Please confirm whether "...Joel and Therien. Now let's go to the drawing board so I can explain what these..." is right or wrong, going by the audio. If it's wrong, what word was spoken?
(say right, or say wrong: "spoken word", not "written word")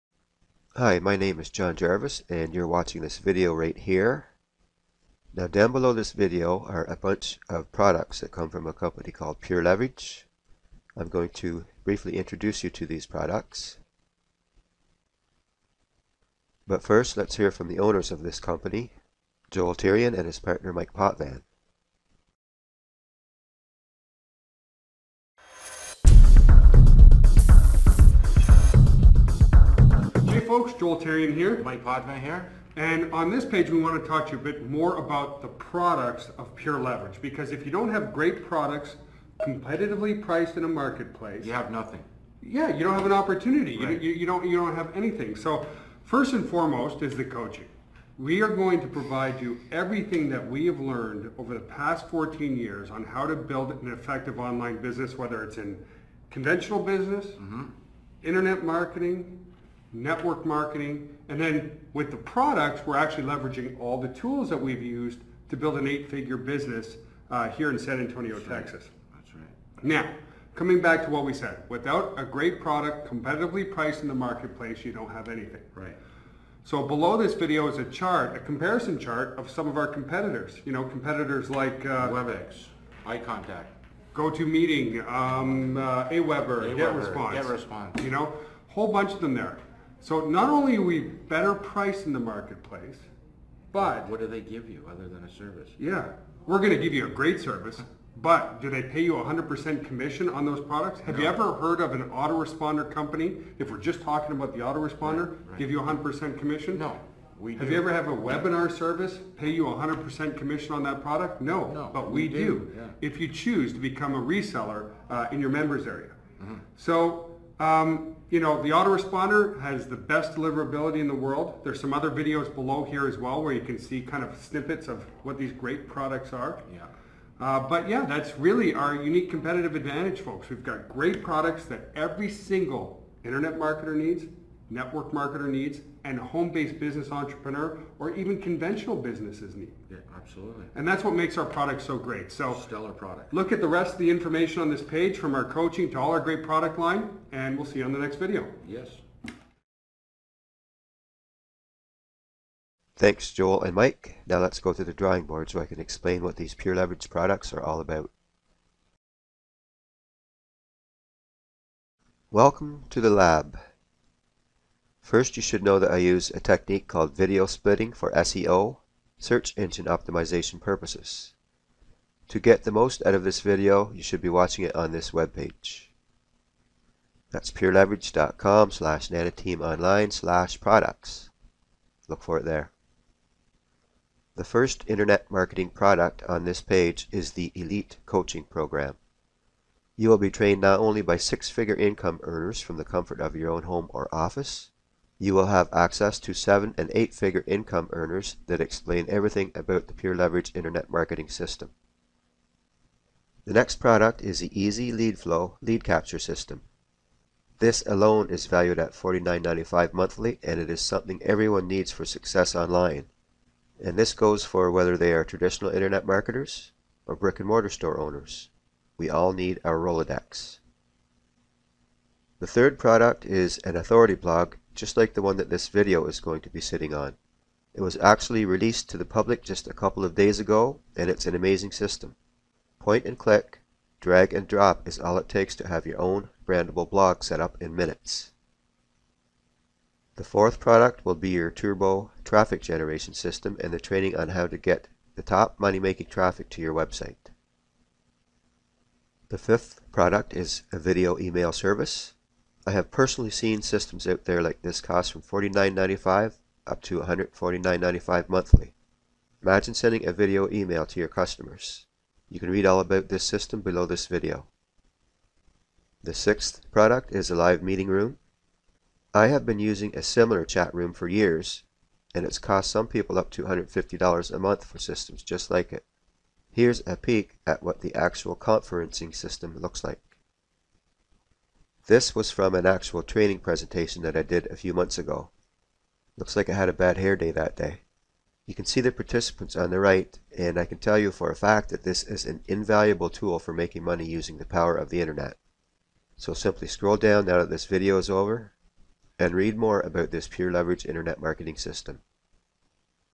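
wrong: "Mike", not "Therien".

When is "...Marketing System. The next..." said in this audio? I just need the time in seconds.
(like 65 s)
200 s.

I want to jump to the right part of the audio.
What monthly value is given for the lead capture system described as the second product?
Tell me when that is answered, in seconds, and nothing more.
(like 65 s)
208 s.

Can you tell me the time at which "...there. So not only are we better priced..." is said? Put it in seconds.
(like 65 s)
89 s.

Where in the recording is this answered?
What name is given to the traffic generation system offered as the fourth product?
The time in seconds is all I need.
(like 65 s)
241 s.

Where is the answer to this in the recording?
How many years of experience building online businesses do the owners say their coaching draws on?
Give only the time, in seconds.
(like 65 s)
52 s.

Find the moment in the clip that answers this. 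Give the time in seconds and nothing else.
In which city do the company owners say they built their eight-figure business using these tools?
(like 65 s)
67 s.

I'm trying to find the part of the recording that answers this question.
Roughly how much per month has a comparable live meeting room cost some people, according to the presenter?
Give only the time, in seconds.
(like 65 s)
273 s.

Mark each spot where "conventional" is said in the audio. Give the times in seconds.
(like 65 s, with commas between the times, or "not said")
56 s, 138 s.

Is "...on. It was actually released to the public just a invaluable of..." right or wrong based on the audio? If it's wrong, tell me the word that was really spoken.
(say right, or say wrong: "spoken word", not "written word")
wrong: "couple", not "invaluable".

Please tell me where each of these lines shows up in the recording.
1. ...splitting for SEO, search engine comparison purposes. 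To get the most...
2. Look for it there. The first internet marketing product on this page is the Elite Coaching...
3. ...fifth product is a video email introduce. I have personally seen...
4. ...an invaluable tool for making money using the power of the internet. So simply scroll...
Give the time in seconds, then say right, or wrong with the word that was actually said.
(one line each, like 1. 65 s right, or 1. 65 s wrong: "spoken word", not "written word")
1. 167 s wrong: "optimization", not "comparison"
2. 182 s right
3. 249 s wrong: "service", not "introduce"
4. 292 s right.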